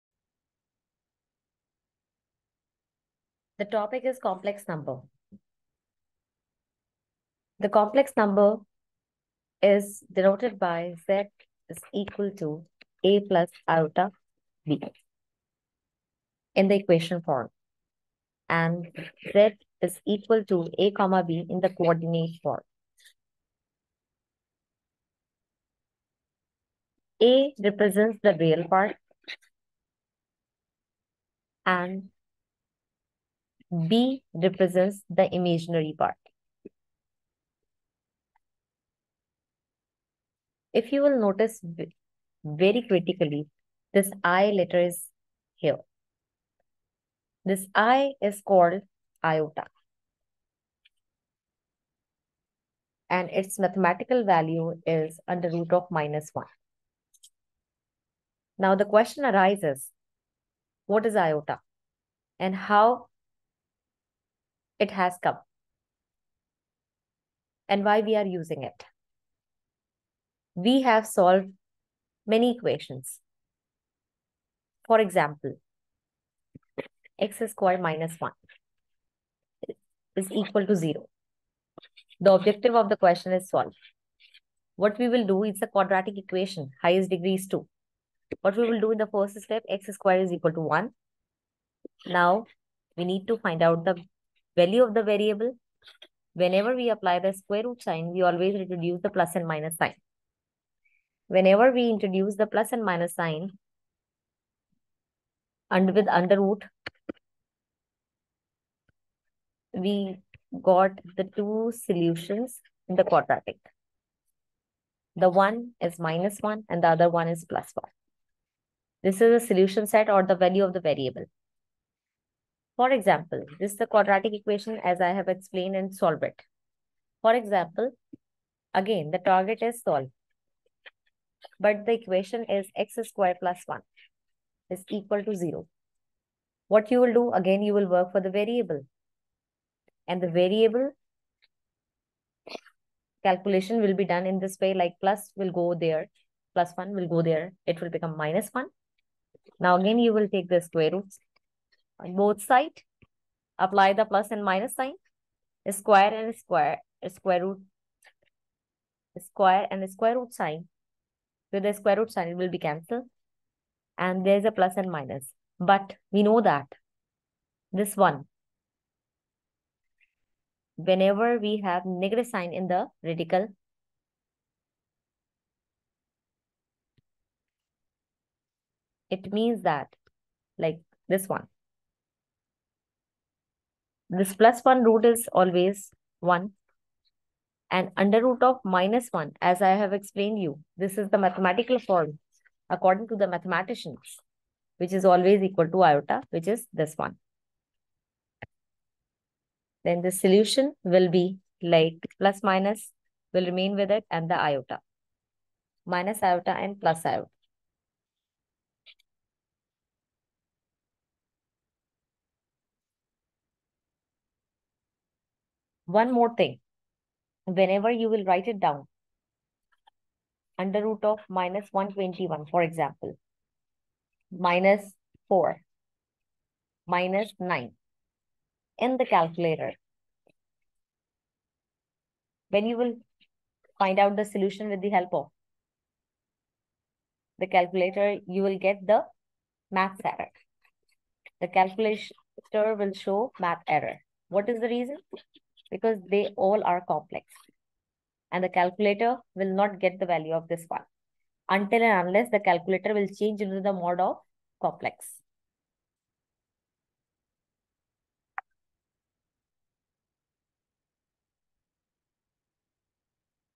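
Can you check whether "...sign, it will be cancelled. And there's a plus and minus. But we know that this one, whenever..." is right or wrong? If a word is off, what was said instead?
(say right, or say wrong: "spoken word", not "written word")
right.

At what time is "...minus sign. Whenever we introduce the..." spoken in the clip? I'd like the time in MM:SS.
01:39.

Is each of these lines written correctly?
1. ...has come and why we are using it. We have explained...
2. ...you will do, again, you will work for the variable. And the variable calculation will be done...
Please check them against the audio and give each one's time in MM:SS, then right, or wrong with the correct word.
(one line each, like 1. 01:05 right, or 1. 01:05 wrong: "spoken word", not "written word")
1. 01:04 wrong: "solved", not "explained"
2. 02:16 right.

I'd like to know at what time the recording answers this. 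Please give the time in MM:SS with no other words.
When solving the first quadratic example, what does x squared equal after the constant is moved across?
01:29.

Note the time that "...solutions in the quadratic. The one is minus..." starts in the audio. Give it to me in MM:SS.
01:51.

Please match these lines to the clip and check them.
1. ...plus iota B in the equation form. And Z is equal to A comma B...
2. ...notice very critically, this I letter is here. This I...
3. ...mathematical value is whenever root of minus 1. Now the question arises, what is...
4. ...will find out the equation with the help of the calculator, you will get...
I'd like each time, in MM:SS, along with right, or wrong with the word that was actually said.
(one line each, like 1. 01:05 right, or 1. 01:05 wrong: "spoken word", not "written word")
1. 00:13 right
2. 00:41 right
3. 00:53 wrong: "under", not "whenever"
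4. 03:52 wrong: "solution", not "equation".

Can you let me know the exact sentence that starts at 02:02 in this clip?
For example, this is the quadratic equation as I have explained and solve it.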